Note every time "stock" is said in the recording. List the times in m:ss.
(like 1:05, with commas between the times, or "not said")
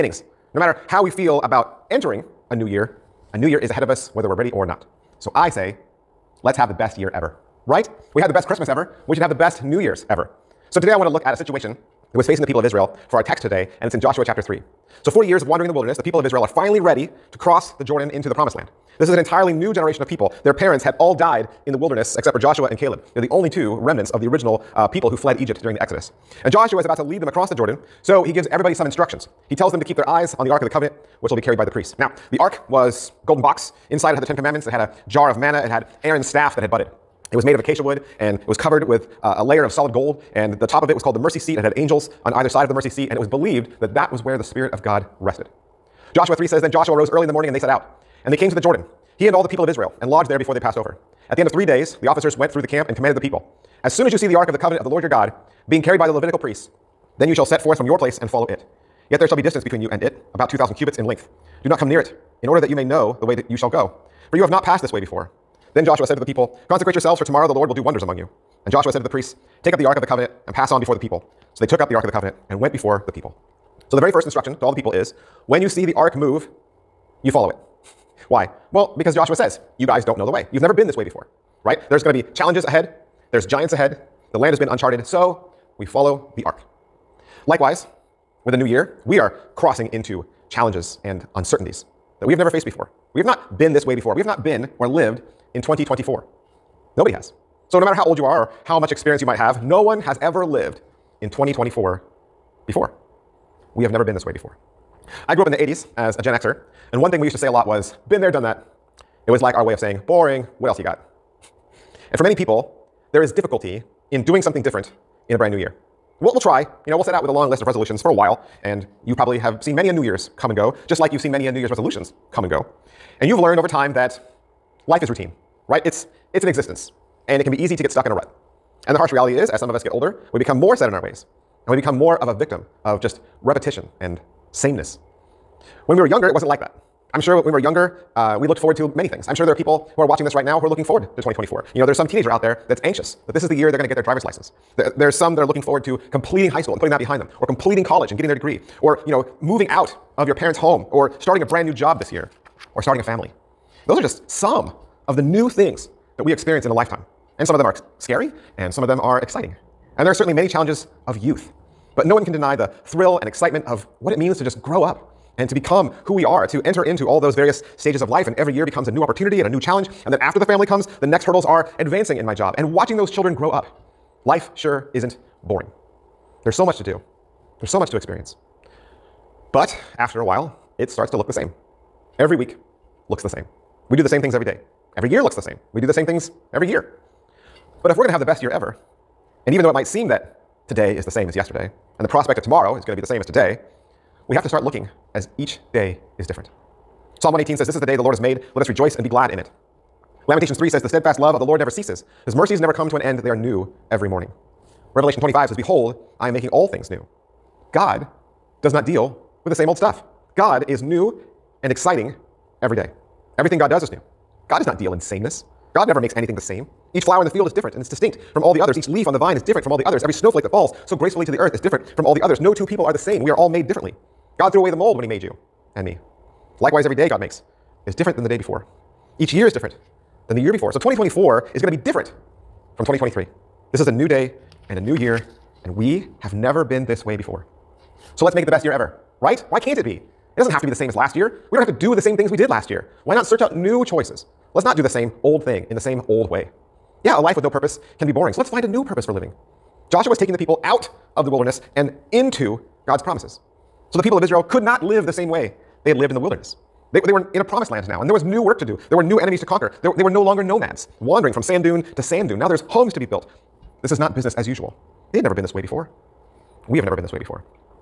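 not said.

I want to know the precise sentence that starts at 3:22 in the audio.
His mercies never come to an end.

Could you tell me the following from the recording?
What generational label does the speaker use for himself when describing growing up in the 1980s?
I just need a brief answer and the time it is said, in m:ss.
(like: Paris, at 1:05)
Gen Xer, at 1:46.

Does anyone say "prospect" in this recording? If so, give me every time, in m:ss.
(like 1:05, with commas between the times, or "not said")
3:12.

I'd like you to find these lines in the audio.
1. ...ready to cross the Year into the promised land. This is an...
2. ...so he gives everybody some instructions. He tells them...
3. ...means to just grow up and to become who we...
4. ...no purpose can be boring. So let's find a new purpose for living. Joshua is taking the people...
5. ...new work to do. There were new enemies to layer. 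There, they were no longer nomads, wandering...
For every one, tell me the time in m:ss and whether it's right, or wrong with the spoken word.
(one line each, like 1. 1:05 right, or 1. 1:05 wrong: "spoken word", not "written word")
1. 0:16 wrong: "Jordan", not "Year"
2. 0:28 right
3. 2:44 right
4. 4:07 right
5. 4:18 wrong: "conquer", not "layer".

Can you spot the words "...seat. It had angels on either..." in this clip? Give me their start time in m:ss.
0:41.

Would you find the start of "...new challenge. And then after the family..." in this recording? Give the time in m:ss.
2:49.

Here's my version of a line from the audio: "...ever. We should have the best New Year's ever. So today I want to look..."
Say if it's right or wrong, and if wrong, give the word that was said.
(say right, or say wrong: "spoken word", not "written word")
right.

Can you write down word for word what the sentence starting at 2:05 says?
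It's, it's an existence, and it can be easy to get stuck in a rut.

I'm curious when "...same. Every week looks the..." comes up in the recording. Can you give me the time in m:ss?
3:01.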